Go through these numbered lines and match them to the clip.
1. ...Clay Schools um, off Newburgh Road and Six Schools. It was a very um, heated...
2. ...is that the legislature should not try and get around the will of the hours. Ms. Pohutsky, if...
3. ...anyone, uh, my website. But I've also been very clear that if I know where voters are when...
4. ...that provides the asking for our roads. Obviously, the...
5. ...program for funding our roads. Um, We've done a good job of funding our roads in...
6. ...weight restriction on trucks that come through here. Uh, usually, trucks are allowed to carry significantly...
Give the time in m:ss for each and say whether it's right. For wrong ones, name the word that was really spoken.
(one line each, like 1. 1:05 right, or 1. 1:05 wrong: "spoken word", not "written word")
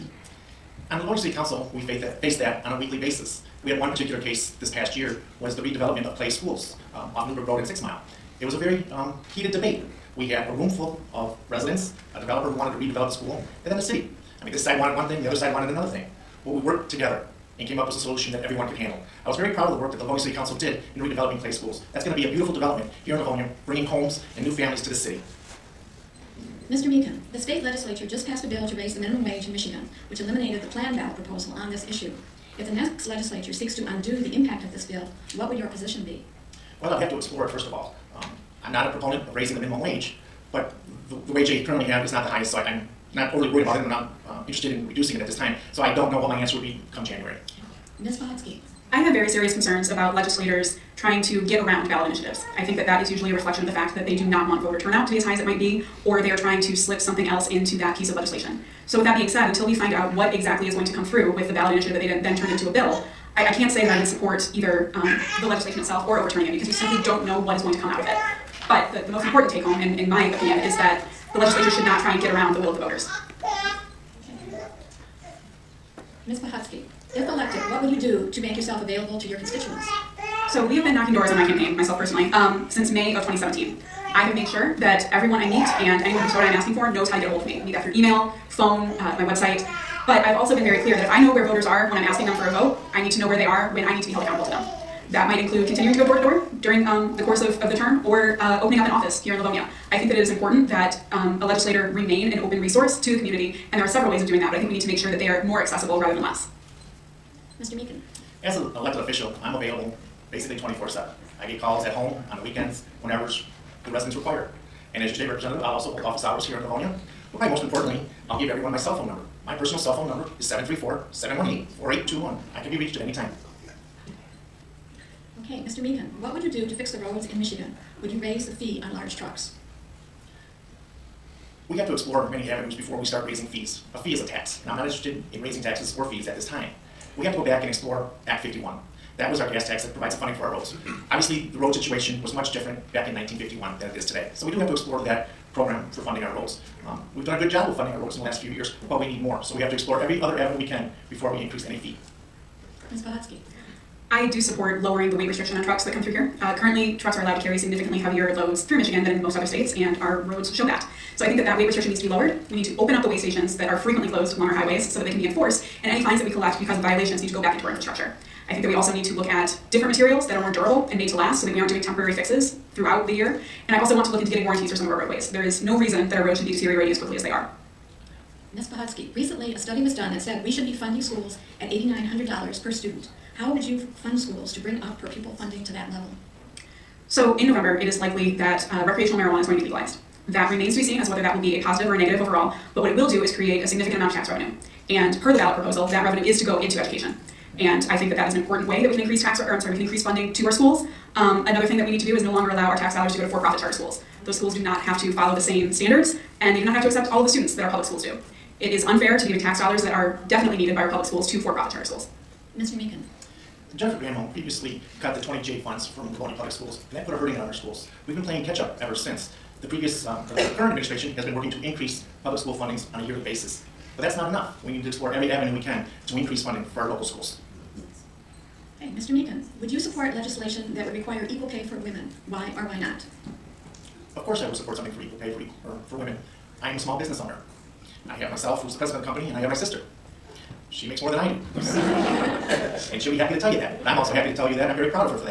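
1. 0:06 wrong: "Mile", not "Schools"
2. 1:10 wrong: "voters", not "hours"
3. 1:28 wrong: "phone", not "anyone"
4. 2:19 wrong: "funding", not "asking"
5. 2:25 right
6. 2:35 wrong: "currently", not "usually".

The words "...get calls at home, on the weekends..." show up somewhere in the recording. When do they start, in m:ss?
1:51.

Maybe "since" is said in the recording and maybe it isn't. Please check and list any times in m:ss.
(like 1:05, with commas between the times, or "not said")
1:22, 3:38.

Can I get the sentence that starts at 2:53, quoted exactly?
And I also want to look into getting warranties for some of our roadways.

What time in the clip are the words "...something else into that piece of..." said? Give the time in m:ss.
0:56.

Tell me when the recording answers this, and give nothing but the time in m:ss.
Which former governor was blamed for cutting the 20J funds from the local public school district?
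3:33.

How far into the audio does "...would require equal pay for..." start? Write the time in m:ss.
3:50.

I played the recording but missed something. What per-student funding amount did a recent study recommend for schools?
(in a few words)
$8,900.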